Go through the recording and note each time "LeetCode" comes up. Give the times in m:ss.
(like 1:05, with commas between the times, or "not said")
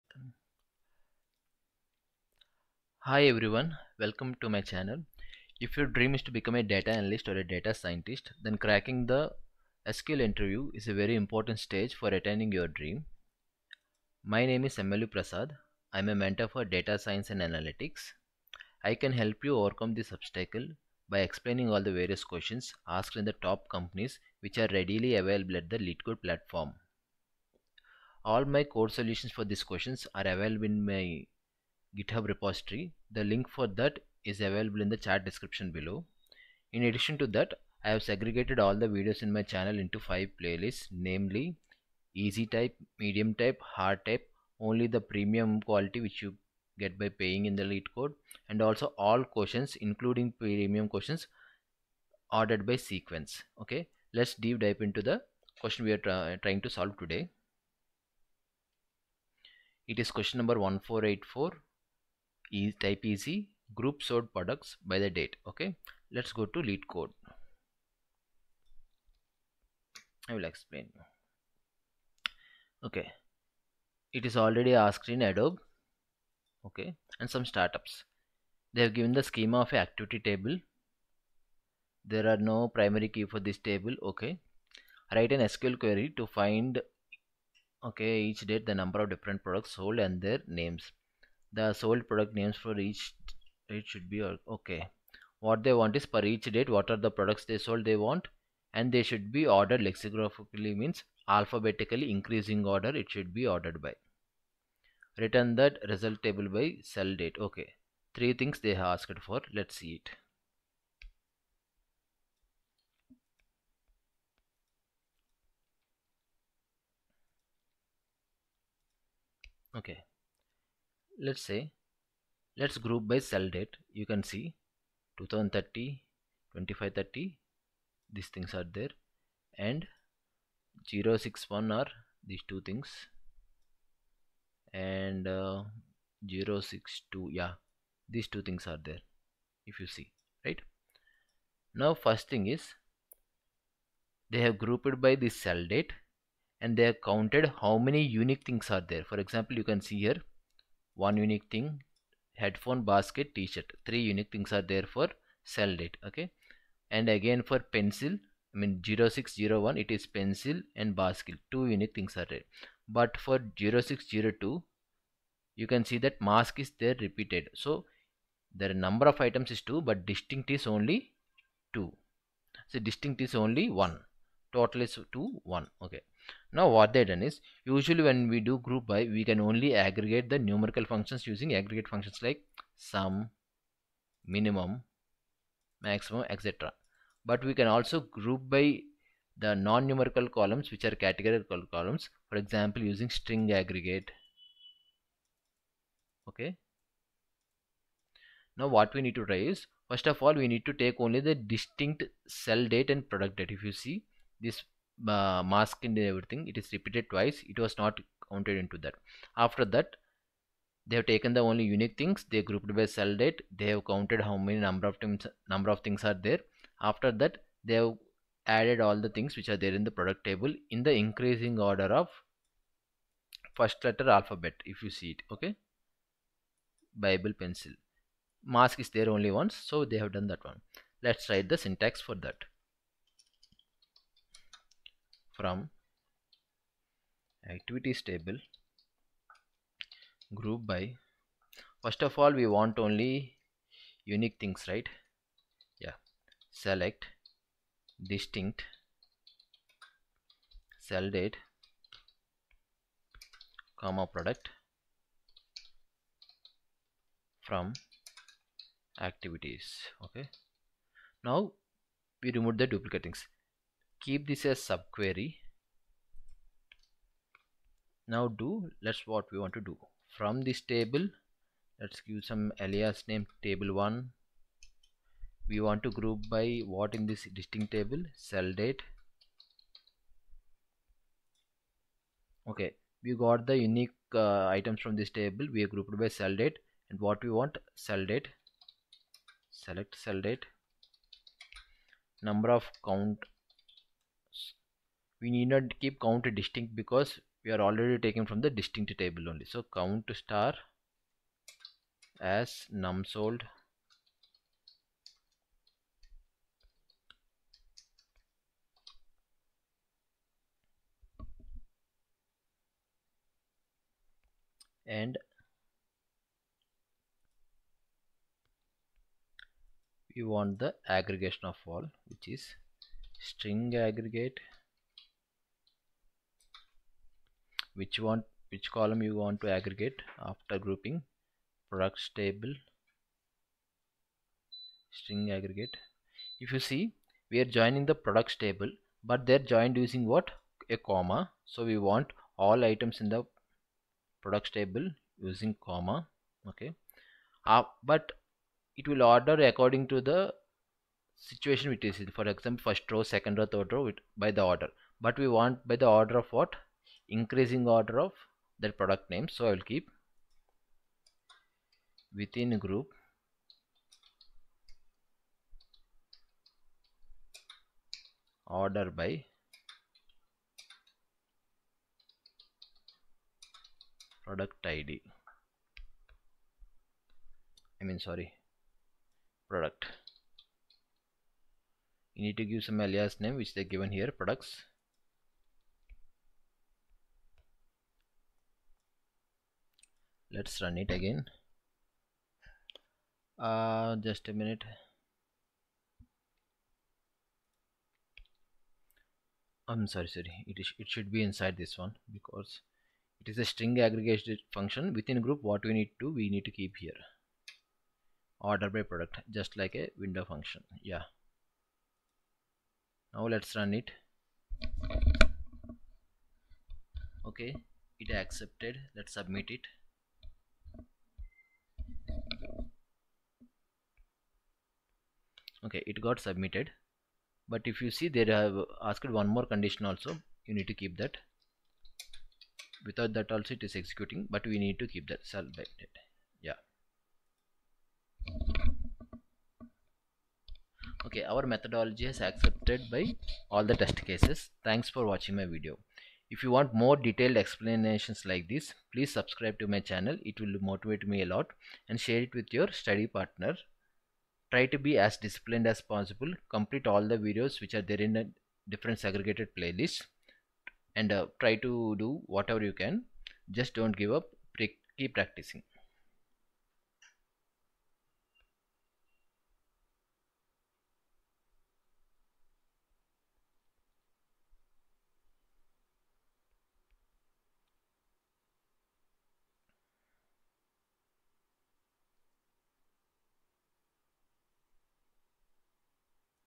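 0:25, 0:47, 1:06.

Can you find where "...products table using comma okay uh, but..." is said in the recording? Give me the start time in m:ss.
5:44.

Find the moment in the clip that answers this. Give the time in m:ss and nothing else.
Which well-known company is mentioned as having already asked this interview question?
1:15.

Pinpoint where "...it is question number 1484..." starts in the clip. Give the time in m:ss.
0:59.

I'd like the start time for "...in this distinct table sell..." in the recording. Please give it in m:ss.
4:36.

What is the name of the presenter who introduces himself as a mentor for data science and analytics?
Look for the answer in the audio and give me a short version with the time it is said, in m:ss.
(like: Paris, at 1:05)
MLV Prasad, at 0:14.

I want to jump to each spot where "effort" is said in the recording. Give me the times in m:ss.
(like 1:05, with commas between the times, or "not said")
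not said.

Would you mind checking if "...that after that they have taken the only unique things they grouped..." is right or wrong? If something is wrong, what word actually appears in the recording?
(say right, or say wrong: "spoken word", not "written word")
right.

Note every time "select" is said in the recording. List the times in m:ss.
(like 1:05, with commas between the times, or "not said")
4:06, 4:49.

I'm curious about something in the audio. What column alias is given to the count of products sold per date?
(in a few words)
num sold.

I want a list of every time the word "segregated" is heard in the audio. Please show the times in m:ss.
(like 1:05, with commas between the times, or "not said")
0:38, 7:38.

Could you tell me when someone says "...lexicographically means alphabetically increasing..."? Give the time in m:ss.
1:39.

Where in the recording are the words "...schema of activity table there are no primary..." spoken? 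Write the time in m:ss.
1:19.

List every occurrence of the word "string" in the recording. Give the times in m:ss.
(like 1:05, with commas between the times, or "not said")
3:13, 5:23, 5:34, 6:43.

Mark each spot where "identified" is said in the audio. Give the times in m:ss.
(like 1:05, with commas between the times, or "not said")
not said.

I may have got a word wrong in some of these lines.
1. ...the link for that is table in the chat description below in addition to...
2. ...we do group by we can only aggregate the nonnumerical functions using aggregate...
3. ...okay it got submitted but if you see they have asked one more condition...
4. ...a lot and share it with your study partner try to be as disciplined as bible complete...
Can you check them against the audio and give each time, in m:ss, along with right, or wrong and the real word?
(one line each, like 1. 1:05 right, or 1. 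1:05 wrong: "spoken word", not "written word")
1. 0:33 wrong: "available", not "table"
2. 2:58 wrong: "numerical", not "nonnumerical"
3. 7:05 right
4. 7:31 wrong: "possible", not "bible".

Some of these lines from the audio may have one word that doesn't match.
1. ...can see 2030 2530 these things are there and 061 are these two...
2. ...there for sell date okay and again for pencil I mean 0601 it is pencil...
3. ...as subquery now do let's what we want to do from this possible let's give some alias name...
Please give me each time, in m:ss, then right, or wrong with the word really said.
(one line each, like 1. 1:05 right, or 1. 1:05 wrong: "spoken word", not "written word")
1. 2:04 right
2. 2:34 right
3. 4:24 wrong: "table", not "possible".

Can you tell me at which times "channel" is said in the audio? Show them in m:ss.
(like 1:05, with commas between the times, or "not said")
0:04, 0:39, 7:29.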